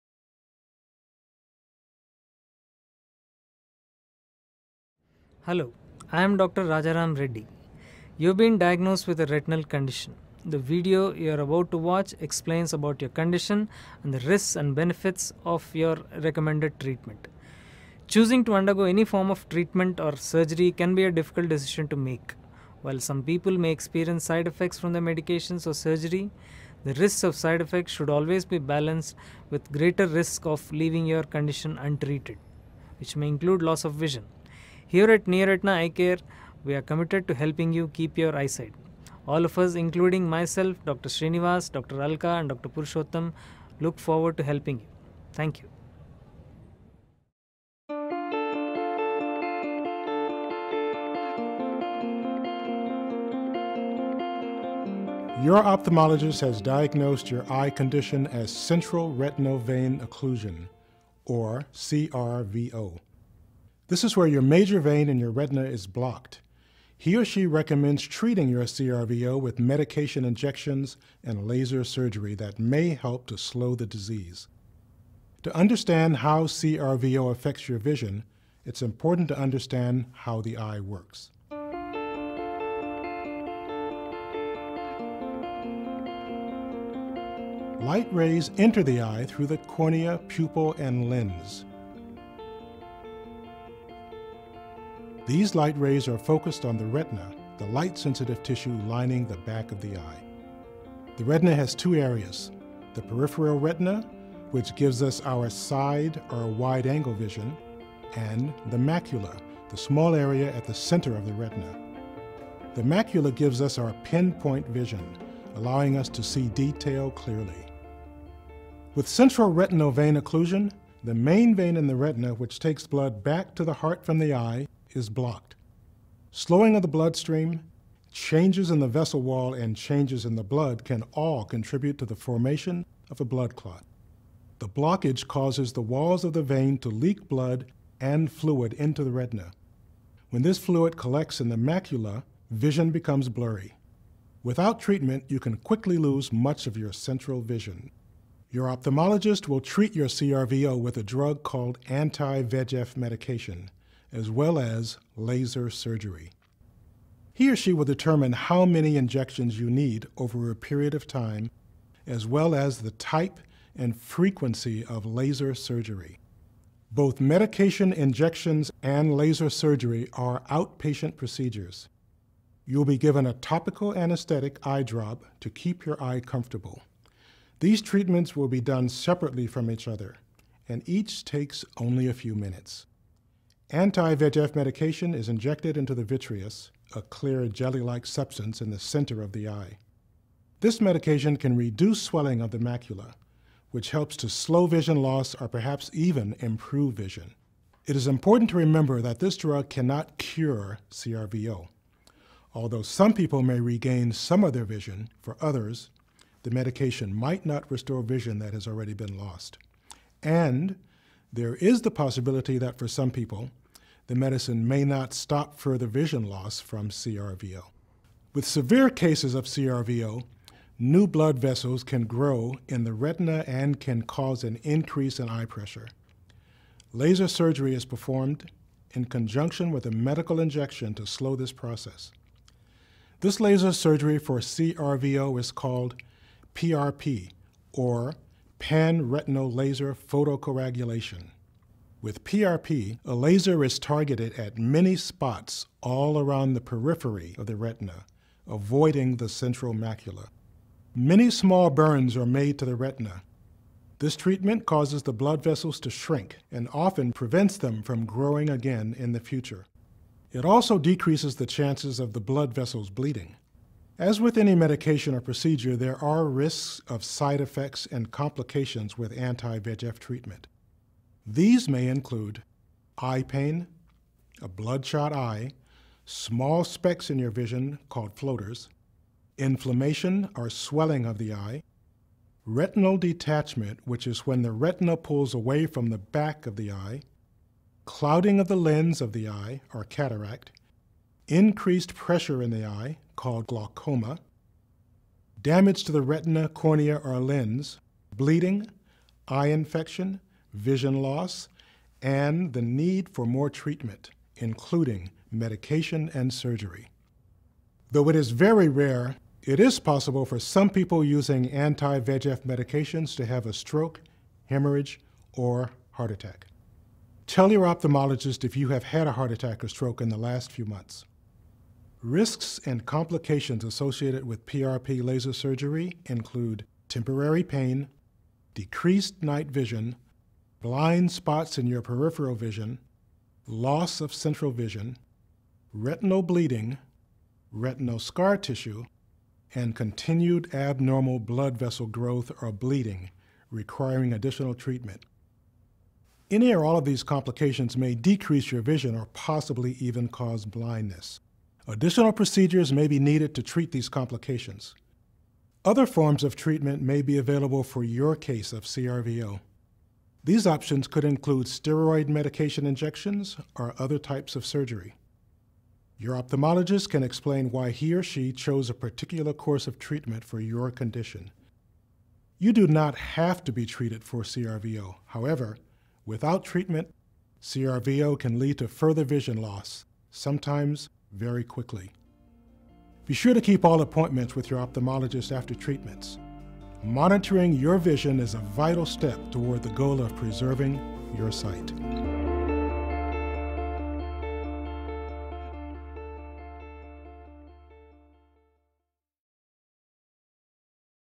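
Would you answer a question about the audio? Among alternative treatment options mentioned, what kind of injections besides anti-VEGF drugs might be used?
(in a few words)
Steroid medication injections.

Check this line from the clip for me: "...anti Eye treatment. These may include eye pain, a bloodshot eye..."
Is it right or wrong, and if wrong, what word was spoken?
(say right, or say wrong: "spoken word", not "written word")
wrong: "VEGF", not "Eye".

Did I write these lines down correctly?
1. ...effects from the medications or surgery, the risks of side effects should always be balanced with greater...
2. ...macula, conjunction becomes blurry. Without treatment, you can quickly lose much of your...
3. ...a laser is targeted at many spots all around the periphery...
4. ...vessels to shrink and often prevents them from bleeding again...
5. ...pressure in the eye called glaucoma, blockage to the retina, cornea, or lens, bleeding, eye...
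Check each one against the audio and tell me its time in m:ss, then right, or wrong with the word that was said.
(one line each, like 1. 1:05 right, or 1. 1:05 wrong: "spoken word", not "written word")
1. 0:24 right
2. 2:21 wrong: "vision", not "conjunction"
3. 4:03 right
4. 4:15 wrong: "growing", not "bleeding"
5. 4:51 wrong: "damage", not "blockage".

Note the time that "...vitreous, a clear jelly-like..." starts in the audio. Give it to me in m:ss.
3:06.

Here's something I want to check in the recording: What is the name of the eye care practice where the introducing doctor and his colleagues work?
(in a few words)
Neoretina Eye Care.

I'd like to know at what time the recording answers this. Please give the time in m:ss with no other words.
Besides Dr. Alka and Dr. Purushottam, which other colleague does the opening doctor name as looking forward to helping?
0:40.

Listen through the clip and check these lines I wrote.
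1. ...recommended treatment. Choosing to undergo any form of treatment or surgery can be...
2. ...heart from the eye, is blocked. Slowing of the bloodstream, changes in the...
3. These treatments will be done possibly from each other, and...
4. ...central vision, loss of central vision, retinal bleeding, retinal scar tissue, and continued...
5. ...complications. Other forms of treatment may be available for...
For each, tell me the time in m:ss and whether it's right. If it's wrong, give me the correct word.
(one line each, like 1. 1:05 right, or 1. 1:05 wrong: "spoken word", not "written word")
1. 0:16 right
2. 2:03 right
3. 2:57 wrong: "separately", not "possibly"
4. 5:31 wrong: "peripheral", not "central"
5. 5:53 right.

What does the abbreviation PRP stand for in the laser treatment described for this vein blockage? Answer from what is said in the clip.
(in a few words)
Panretinal laser photocoagulation.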